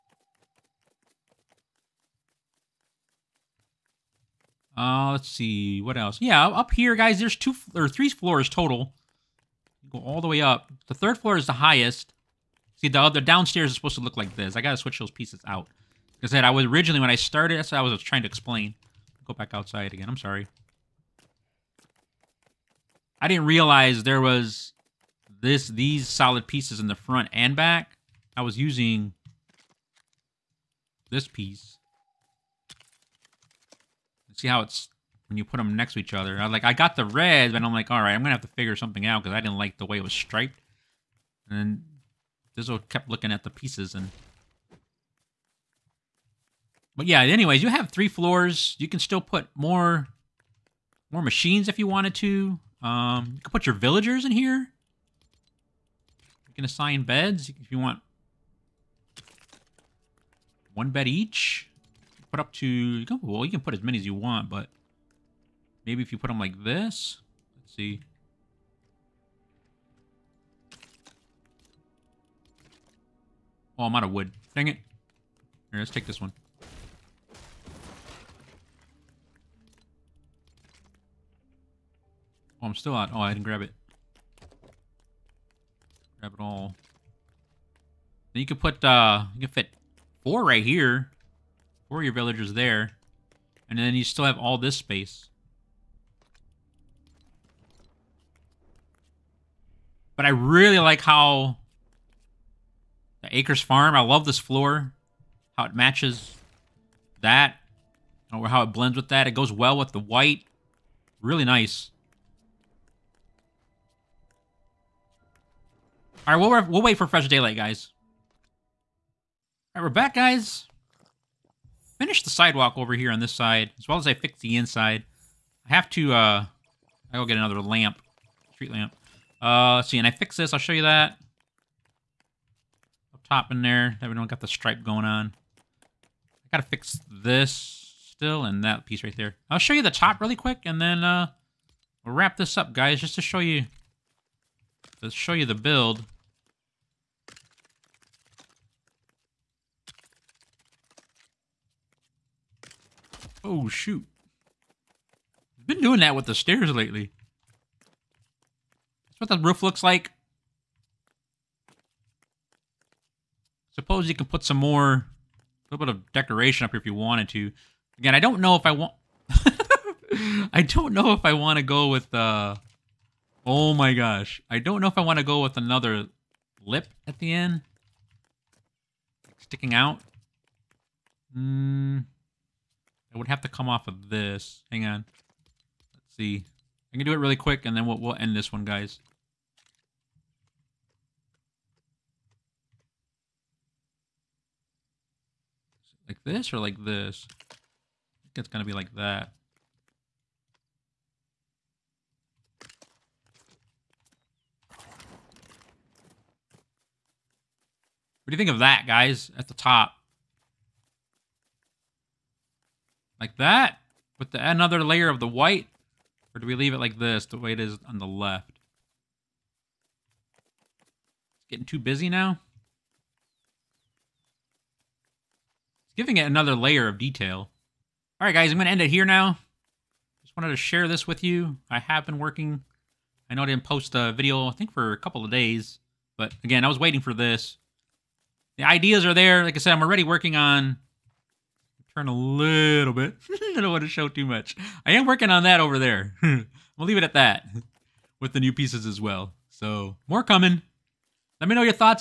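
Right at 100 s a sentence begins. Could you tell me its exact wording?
But I really like how the Acres Farm, I love this floor.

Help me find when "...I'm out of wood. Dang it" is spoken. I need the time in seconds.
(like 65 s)
73 s.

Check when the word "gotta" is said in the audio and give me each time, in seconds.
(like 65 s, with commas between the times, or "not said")
14 s, 136 s.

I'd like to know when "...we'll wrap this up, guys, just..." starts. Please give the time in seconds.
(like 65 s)
142 s.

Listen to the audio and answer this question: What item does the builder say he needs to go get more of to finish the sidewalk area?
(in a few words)
Street lamp.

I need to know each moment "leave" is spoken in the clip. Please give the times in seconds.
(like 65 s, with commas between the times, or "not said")
216 s, 246 s.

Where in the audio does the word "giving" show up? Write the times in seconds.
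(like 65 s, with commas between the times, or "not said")
225 s.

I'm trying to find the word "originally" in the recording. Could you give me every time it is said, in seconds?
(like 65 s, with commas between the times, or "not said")
16 s.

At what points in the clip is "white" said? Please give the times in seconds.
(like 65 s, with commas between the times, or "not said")
110 s, 215 s.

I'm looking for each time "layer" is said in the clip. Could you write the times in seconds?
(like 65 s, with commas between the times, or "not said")
214 s, 226 s.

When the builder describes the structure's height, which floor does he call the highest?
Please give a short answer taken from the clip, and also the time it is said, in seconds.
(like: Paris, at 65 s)
Third floor, at 10 s.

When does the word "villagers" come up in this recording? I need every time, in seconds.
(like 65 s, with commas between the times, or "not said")
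53 s, 92 s.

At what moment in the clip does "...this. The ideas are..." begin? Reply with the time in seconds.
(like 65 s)
237 s.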